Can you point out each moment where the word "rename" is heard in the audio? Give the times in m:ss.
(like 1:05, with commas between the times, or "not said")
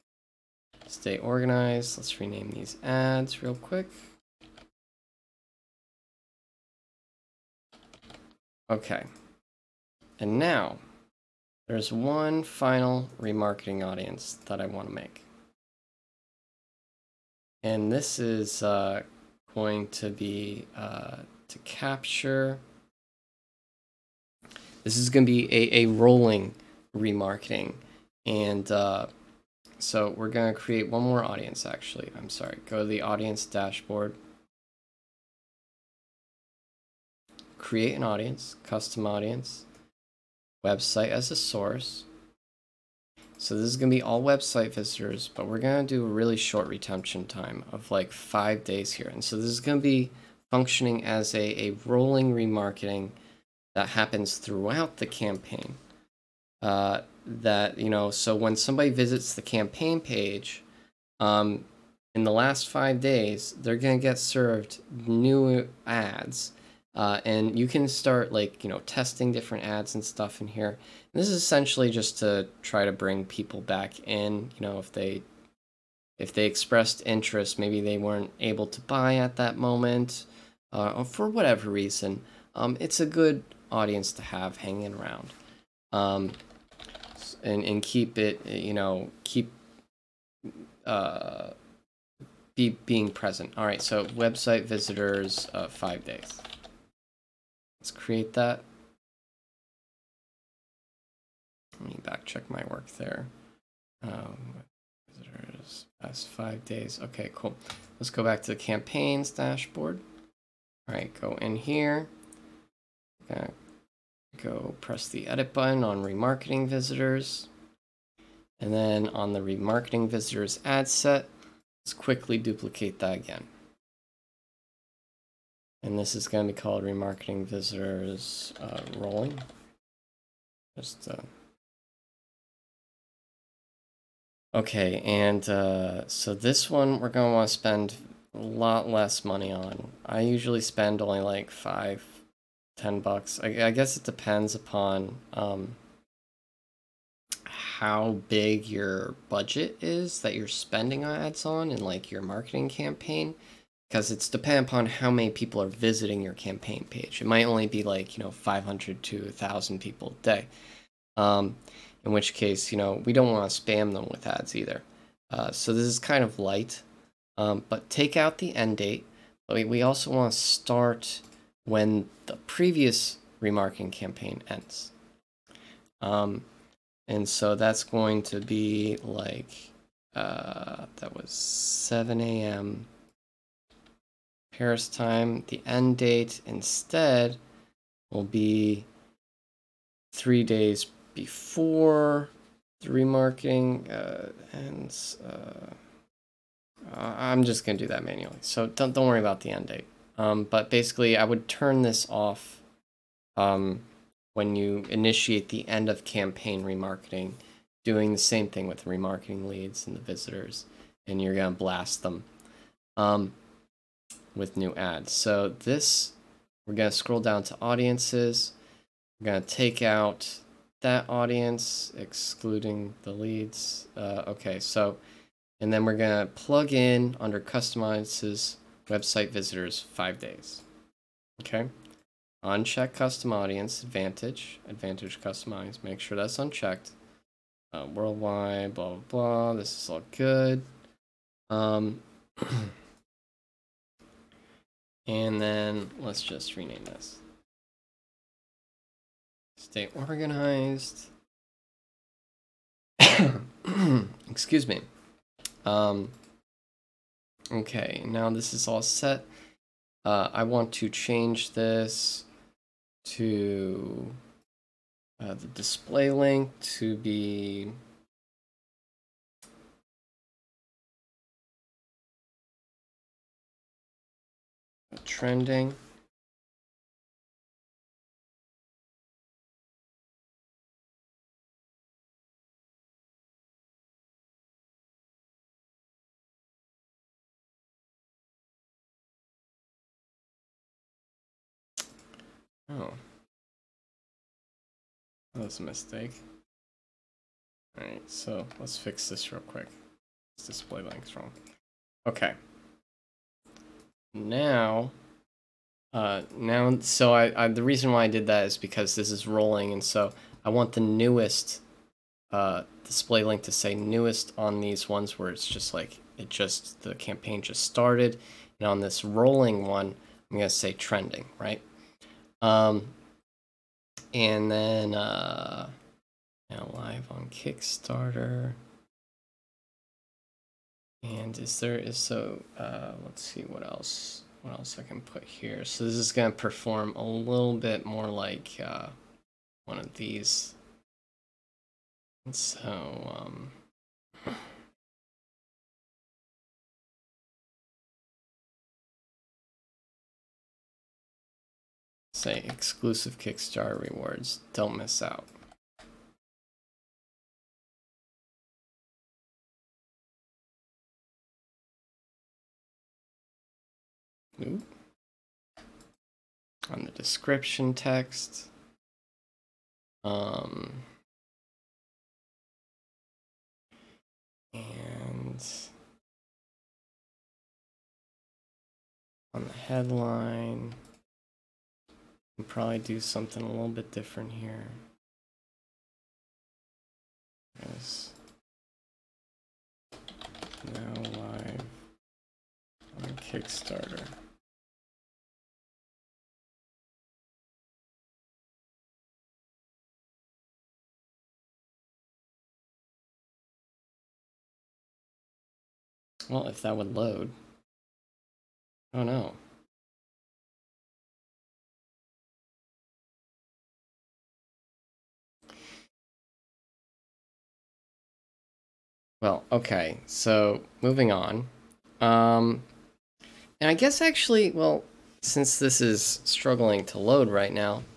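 0:02, 4:06.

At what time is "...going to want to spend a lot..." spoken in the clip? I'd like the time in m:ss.
2:17.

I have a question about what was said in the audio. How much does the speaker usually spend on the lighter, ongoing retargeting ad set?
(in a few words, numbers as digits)
5 to 10 dollars.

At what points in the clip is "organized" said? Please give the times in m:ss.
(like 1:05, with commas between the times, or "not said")
0:01, 4:09.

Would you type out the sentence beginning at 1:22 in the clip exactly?
Um, it's a good audience to have hanging around um, and, and keep it, you know, keep uh, be being present.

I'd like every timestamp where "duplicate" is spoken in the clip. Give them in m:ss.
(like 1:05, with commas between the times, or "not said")
2:02.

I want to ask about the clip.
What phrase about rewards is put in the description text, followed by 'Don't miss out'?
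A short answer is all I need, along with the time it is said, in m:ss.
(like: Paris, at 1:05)
exclusive Kickstarter rewards, at 5:52.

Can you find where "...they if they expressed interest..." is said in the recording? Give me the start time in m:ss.
1:14.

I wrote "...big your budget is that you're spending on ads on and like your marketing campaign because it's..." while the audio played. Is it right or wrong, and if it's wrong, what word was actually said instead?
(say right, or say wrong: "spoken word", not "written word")
right.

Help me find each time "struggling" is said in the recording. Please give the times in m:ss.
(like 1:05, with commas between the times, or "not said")
7:06.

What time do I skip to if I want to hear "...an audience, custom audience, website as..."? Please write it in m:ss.
0:37.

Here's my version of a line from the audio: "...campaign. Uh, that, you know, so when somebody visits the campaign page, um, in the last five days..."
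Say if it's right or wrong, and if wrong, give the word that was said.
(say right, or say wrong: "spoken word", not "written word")
right.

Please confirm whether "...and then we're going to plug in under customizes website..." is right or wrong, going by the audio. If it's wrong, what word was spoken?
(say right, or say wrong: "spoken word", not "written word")
right.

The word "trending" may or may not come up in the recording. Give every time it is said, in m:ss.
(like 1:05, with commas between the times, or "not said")
4:35, 5:20.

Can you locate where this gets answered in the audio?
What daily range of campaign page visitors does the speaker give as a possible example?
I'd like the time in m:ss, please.
2:38.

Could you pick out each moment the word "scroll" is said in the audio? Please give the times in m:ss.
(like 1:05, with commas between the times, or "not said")
3:36.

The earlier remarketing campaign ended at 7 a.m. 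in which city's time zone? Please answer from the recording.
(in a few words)
Paris.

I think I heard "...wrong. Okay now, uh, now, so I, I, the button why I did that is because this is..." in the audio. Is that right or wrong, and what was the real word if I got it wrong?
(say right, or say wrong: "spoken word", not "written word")
wrong: "reason", not "button".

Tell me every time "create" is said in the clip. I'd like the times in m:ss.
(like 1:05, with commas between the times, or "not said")
0:30, 0:37, 1:37.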